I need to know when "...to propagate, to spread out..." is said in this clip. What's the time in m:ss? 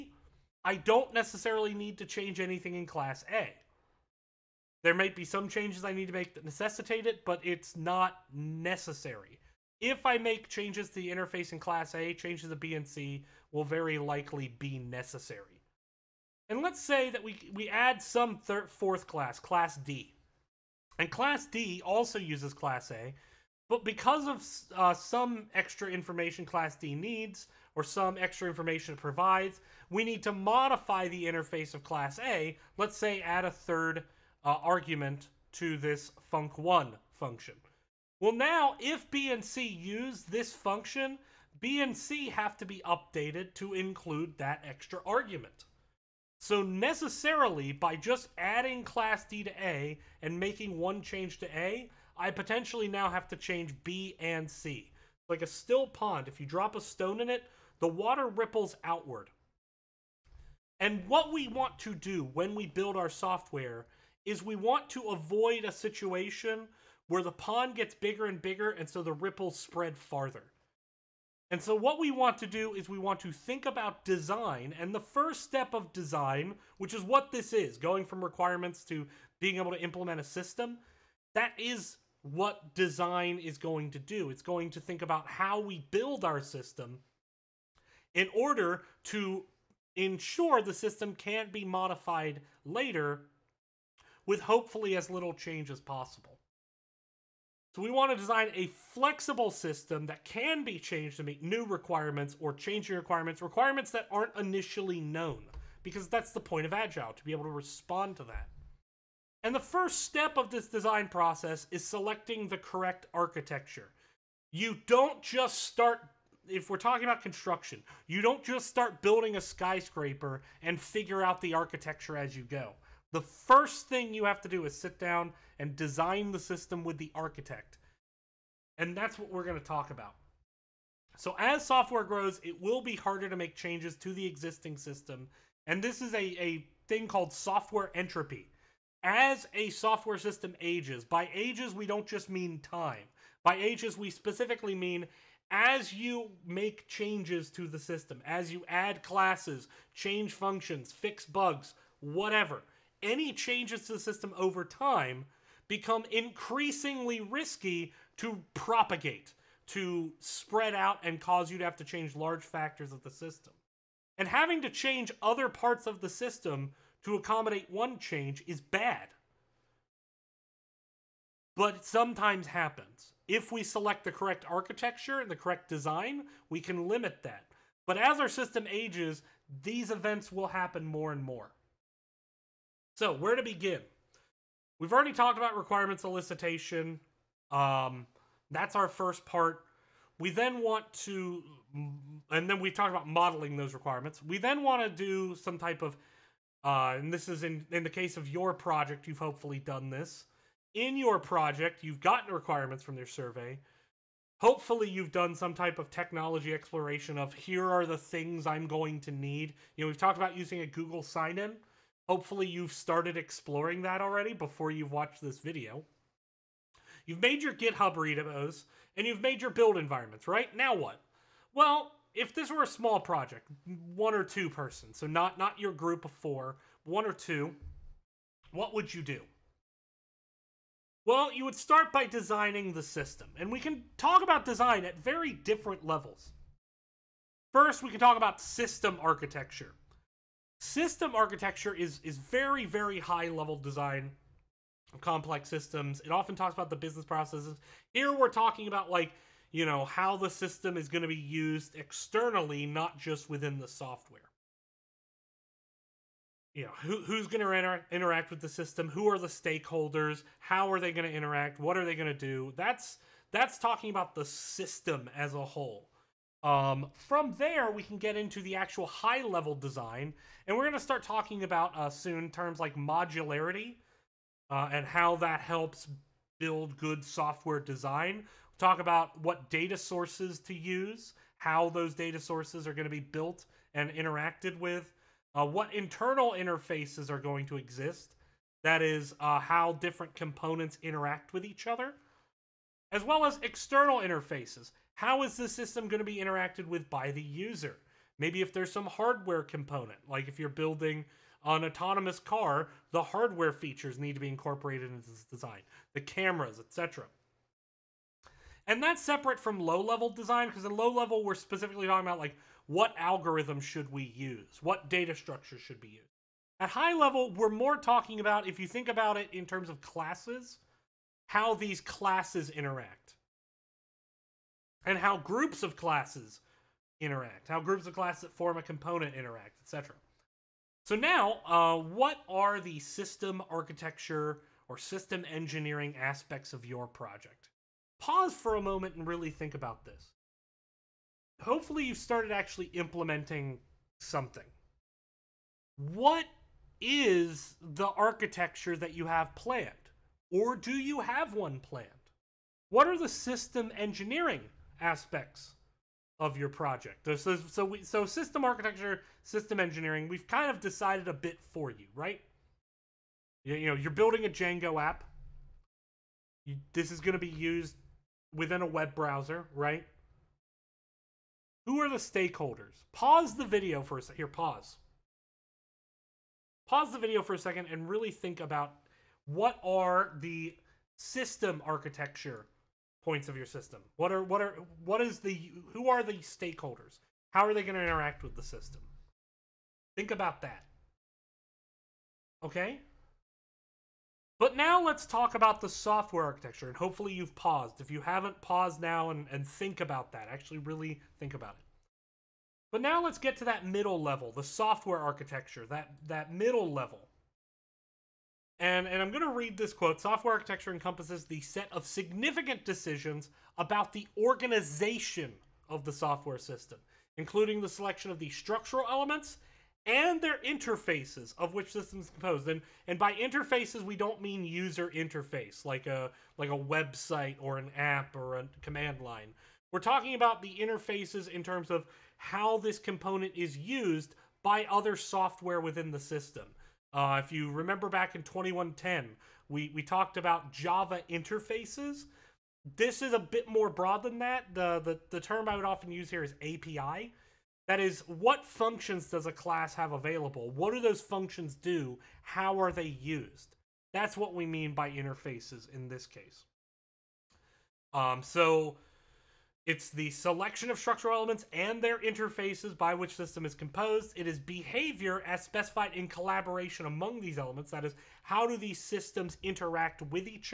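2:38.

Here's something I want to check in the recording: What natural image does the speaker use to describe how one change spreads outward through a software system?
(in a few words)
A still pond.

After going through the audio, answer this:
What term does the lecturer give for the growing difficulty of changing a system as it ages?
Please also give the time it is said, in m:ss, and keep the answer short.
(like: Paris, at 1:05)
Software entropy, at 2:17.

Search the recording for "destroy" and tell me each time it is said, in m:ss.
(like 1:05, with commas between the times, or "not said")
not said.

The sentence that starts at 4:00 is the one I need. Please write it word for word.
System architecture is is very very high level design of complex systems.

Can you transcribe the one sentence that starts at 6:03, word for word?
You, you know, you're building a Django app.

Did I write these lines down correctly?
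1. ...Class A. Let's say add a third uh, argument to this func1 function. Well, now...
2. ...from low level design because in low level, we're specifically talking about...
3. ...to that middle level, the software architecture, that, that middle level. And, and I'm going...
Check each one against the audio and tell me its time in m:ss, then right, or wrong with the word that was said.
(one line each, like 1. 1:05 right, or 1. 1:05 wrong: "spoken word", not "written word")
1. 0:31 right
2. 5:09 right
3. 6:43 right.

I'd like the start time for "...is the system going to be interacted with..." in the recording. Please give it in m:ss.
4:55.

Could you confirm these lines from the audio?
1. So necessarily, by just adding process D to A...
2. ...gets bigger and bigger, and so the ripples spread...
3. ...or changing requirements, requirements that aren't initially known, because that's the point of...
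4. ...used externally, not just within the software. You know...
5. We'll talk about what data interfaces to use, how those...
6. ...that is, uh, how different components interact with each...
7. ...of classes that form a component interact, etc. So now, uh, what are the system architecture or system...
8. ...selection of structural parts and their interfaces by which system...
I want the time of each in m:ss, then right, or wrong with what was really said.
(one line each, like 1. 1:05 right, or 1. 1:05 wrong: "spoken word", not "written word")
1. 0:46 wrong: "class", not "process"
2. 1:07 right
3. 1:42 right
4. 4:11 right
5. 4:38 wrong: "sources", not "interfaces"
6. 4:48 right
7. 5:27 right
8. 7:40 wrong: "elements", not "parts".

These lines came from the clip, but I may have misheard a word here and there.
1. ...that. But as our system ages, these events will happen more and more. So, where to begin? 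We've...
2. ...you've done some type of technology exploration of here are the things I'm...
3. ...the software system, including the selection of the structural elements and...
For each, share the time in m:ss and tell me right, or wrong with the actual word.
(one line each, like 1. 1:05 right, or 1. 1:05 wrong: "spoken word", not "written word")
1. 2:57 right
2. 3:24 right
3. 6:55 right.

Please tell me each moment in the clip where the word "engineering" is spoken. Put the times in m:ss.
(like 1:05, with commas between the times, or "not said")
5:35, 5:53, 5:59.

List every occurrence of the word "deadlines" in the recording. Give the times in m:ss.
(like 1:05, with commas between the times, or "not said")
not said.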